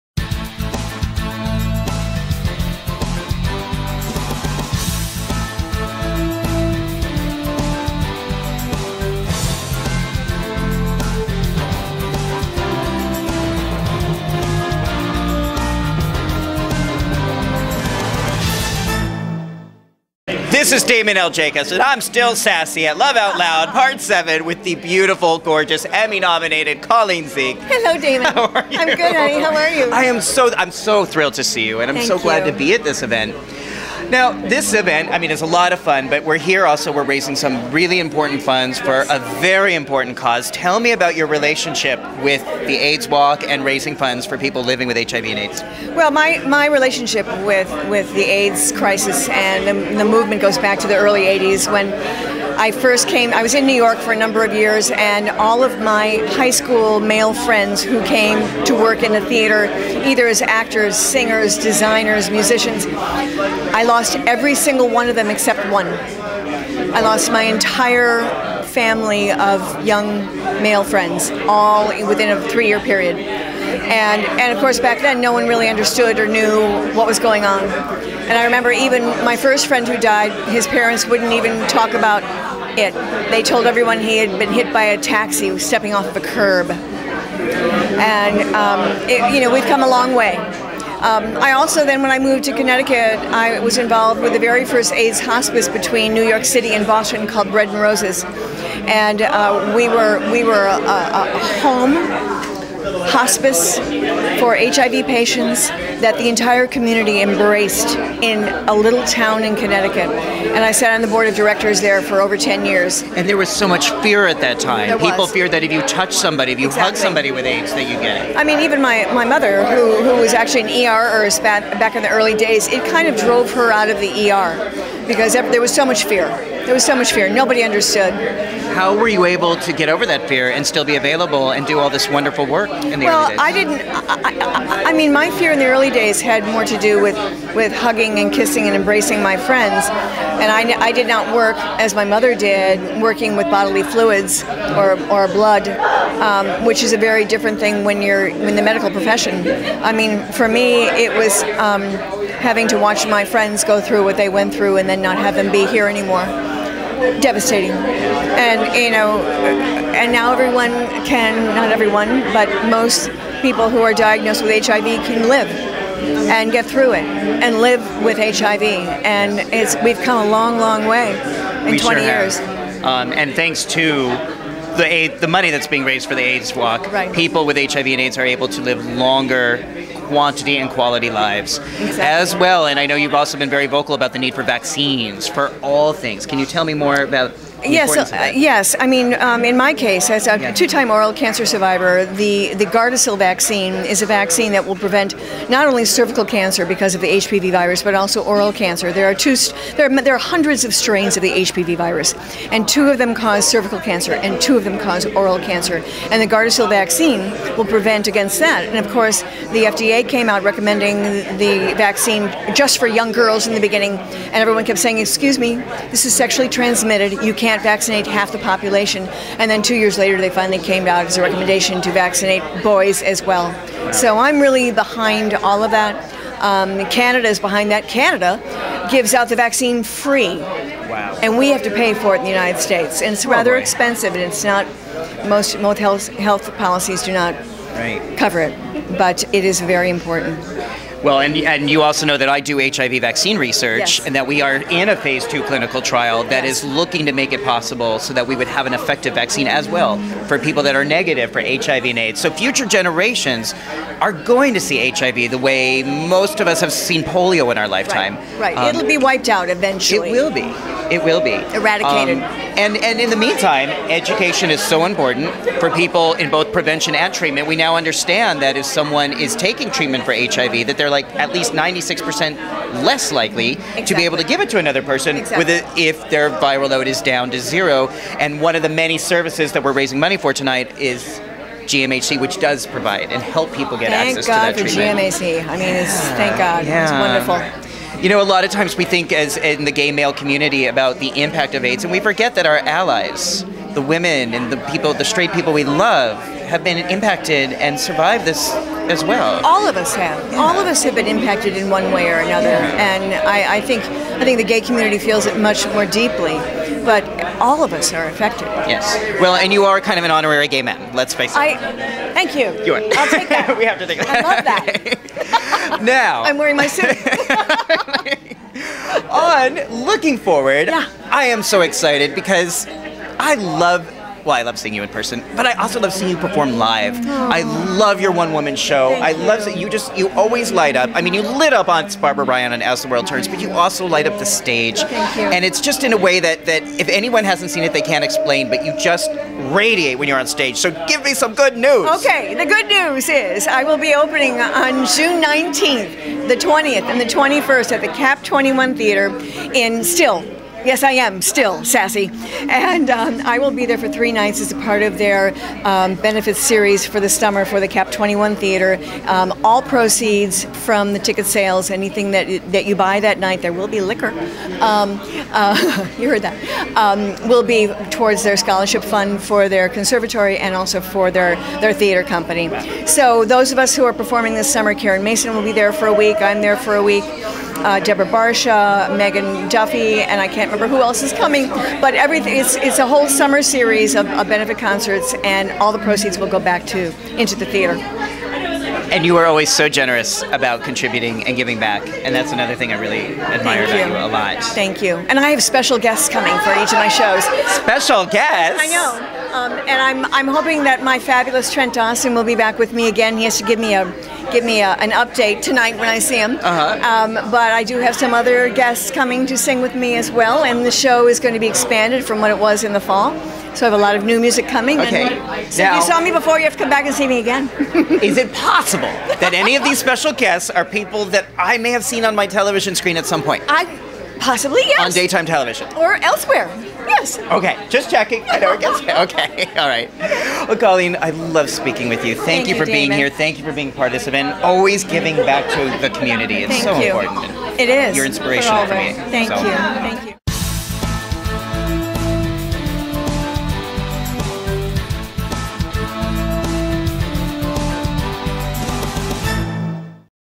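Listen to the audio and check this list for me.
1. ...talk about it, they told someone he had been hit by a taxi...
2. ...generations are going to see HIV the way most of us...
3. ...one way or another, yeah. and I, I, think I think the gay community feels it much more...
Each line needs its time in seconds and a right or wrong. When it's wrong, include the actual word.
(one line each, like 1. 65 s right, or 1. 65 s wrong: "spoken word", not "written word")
1. 81 s wrong: "everyone", not "someone"
2. 252 s right
3. 301 s right.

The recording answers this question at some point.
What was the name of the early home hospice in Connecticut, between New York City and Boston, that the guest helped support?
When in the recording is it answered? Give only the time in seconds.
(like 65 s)
97 s.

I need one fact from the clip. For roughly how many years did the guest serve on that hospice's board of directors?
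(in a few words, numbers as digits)
over 10 years.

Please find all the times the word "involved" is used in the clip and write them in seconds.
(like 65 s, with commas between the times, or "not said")
93 s.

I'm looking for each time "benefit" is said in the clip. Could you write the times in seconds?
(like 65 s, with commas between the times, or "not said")
355 s, 384 s.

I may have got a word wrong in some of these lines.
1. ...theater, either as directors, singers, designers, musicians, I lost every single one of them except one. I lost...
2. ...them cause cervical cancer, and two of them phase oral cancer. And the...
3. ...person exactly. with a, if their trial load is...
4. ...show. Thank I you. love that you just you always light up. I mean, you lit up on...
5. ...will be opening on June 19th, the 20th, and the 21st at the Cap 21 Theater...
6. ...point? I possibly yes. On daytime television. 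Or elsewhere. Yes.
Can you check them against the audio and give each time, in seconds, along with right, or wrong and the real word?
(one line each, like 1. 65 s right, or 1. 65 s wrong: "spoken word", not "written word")
1. 59 s wrong: "actors", not "directors"
2. 202 s wrong: "cause", not "phase"
3. 274 s wrong: "viral", not "trial"
4. 328 s right
5. 343 s right
6. 423 s right.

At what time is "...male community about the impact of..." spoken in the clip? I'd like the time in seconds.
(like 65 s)
289 s.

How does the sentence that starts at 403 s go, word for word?
He has to give me a give me a, an update tonight when I see him.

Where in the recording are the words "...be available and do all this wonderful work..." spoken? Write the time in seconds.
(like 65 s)
130 s.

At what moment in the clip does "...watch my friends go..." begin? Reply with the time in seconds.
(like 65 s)
152 s.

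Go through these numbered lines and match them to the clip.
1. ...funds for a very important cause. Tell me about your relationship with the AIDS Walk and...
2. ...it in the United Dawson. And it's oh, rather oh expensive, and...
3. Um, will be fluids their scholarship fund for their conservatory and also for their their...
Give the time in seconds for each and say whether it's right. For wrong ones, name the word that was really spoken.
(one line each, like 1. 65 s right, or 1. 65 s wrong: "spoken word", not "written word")
1. 38 s right
2. 232 s wrong: "States", not "Dawson"
3. 366 s wrong: "towards", not "fluids".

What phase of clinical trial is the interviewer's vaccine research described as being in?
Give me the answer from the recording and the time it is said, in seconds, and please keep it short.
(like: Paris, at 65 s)
phase two, at 244 s.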